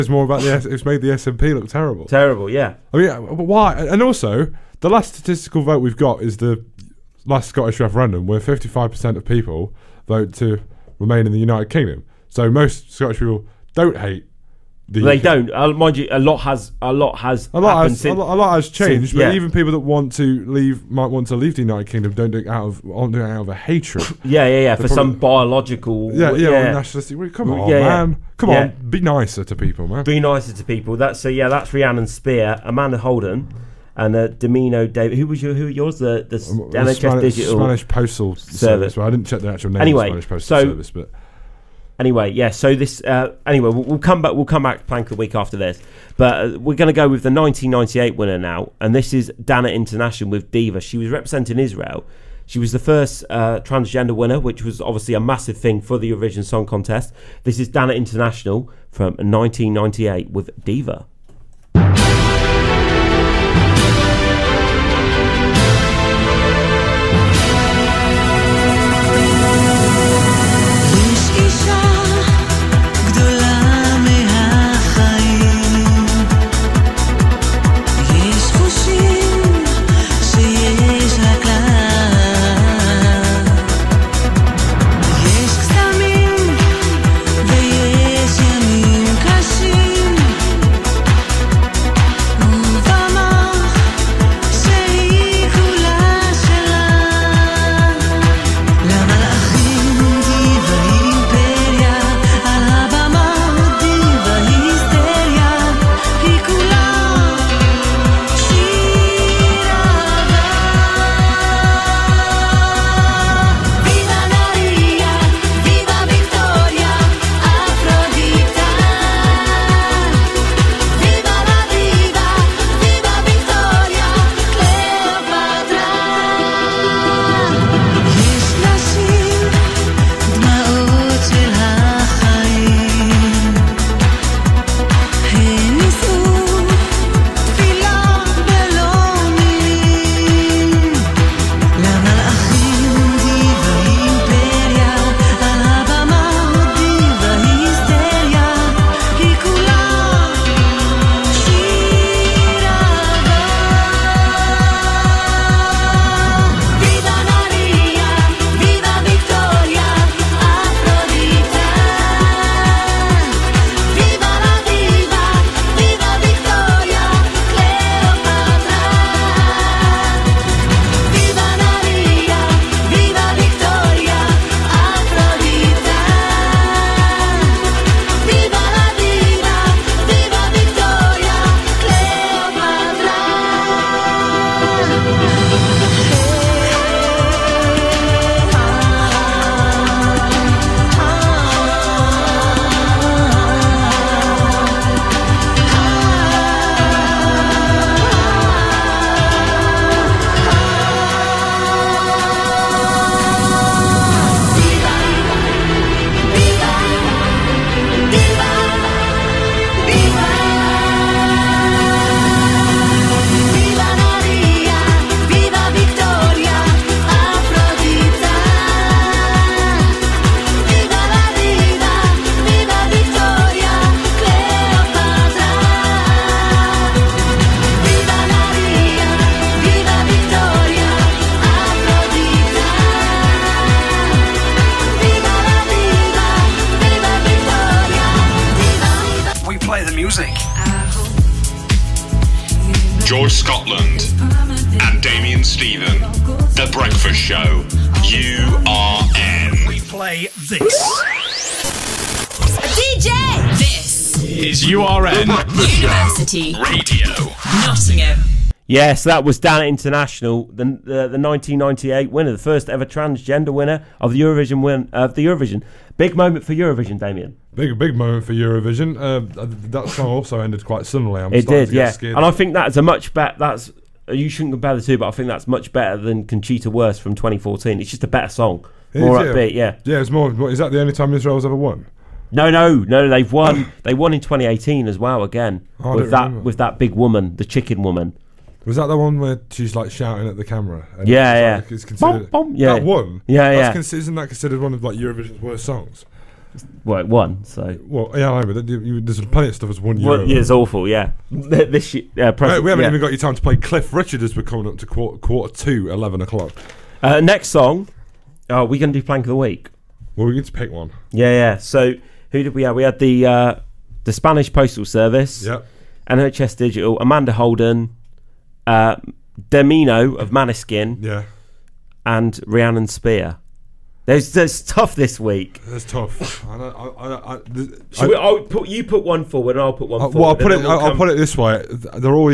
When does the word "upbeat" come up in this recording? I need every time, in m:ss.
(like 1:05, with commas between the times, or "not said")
4:39.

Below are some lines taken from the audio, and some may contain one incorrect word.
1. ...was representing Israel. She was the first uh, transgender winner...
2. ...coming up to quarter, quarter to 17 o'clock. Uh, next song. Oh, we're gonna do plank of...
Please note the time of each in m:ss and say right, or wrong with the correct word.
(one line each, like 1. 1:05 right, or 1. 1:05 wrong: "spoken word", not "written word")
1. 0:50 right
2. 5:04 wrong: "11", not "17".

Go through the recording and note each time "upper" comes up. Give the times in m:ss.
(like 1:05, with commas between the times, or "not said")
not said.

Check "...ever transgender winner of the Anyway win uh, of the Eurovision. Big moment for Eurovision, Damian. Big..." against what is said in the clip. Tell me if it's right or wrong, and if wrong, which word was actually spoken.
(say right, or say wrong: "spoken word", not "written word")
wrong: "Eurovision", not "Anyway".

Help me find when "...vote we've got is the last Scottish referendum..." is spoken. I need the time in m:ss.
0:05.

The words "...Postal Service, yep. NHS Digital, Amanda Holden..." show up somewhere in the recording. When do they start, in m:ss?
5:14.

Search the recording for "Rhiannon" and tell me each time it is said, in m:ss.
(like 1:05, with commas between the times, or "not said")
0:31, 5:22.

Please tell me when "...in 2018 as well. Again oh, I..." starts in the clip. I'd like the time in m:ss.
4:44.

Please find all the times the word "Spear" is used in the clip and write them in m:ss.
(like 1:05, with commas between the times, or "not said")
0:32, 5:22.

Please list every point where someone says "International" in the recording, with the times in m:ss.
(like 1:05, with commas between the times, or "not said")
0:49, 0:57, 4:19.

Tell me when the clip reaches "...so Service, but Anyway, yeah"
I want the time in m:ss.
0:40.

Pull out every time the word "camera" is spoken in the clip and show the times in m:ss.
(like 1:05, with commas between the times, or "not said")
4:50.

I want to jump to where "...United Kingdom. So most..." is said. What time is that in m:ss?
0:11.